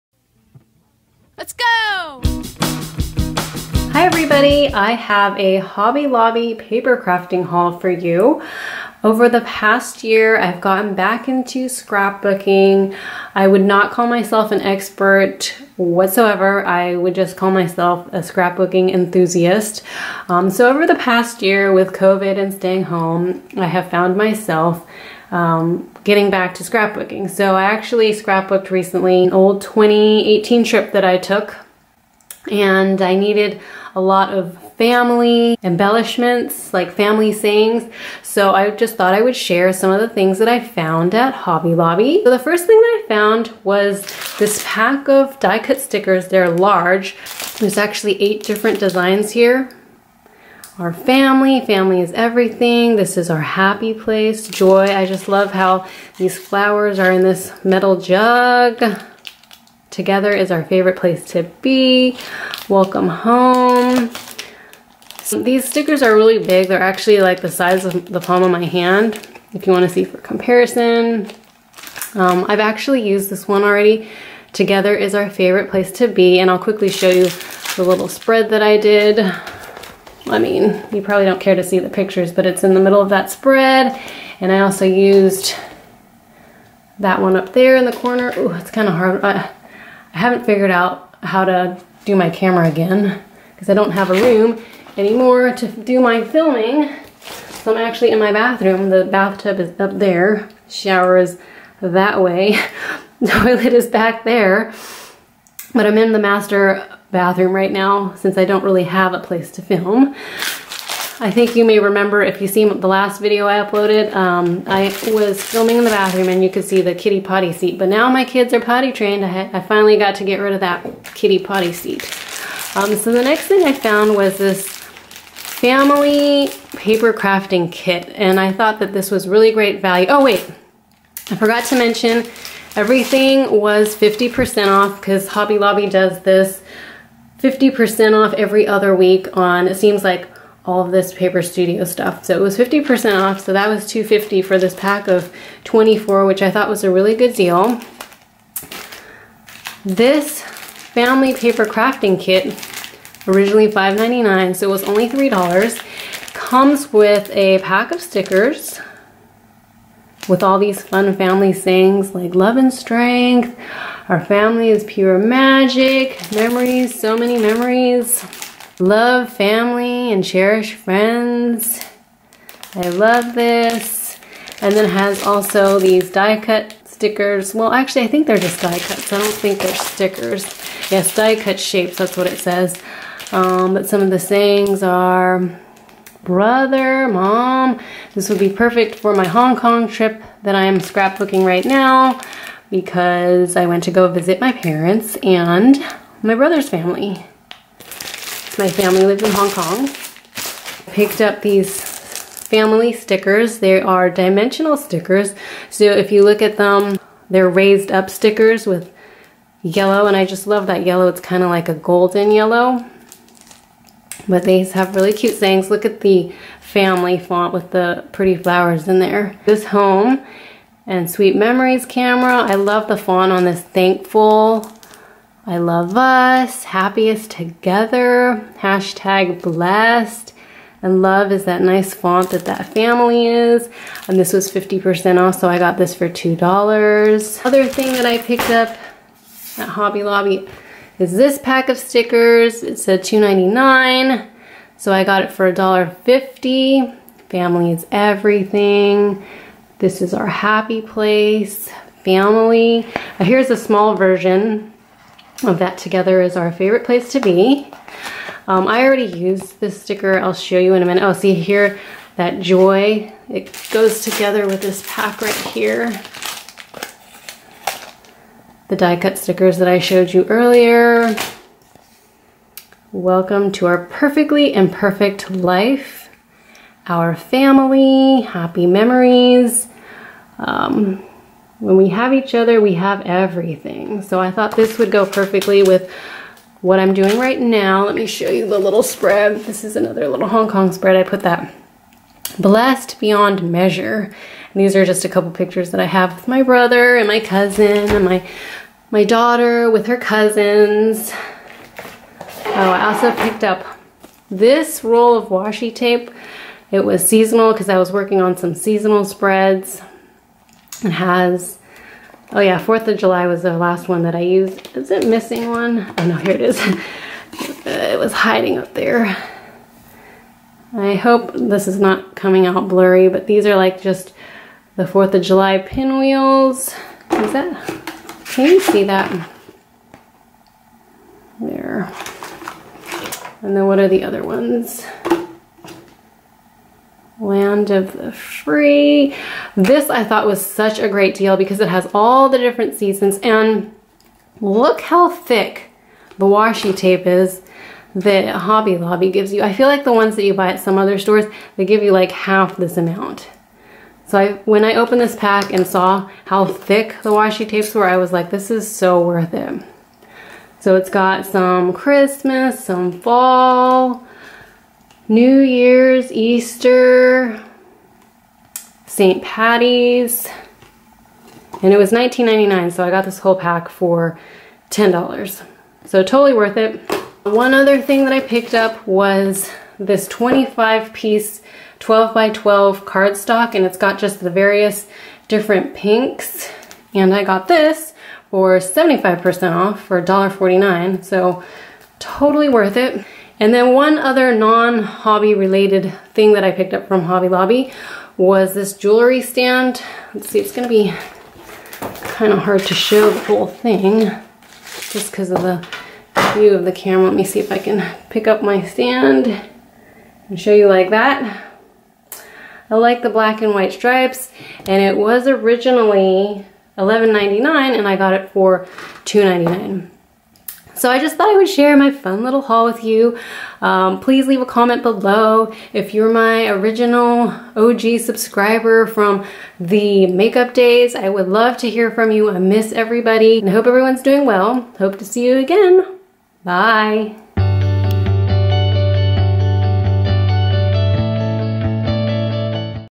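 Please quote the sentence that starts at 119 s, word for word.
I, I finally got to get rid of that kitty potty seat.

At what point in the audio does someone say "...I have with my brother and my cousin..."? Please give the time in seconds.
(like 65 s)
295 s.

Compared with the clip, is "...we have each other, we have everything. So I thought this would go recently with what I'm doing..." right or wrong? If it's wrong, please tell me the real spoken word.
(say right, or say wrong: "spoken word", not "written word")
wrong: "perfectly", not "recently".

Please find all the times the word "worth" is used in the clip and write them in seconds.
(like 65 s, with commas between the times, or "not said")
359 s, 376 s, 392 s.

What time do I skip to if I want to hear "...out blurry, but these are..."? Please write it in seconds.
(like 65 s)
322 s.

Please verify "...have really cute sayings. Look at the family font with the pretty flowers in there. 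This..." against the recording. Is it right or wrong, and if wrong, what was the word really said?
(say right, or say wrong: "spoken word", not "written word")
right.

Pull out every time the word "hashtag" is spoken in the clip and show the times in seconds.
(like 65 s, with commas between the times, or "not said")
228 s.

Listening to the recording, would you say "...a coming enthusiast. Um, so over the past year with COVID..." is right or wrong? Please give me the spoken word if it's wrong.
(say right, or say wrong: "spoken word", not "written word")
wrong: "scrapbooking", not "coming".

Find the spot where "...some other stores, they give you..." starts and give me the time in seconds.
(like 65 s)
350 s.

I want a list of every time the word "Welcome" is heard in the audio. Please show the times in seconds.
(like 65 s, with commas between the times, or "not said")
62 s, 272 s.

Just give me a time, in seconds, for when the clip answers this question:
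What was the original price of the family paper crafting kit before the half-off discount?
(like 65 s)
153 s.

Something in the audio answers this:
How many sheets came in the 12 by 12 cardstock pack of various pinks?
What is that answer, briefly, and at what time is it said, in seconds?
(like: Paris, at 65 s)
25, at 380 s.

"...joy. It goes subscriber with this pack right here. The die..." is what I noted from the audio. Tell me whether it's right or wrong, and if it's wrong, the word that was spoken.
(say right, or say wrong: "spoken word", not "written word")
wrong: "together", not "subscriber".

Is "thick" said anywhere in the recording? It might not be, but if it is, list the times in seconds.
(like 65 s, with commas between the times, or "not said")
345 s, 356 s.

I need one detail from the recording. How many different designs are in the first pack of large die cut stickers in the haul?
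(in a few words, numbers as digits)
8.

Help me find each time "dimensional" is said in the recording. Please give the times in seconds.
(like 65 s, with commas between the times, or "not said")
204 s.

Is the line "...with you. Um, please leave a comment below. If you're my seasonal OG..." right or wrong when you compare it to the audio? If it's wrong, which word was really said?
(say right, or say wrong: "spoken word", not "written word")
wrong: "original", not "seasonal".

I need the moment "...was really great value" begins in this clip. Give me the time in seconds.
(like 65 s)
129 s.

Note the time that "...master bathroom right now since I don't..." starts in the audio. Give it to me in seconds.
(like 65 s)
106 s.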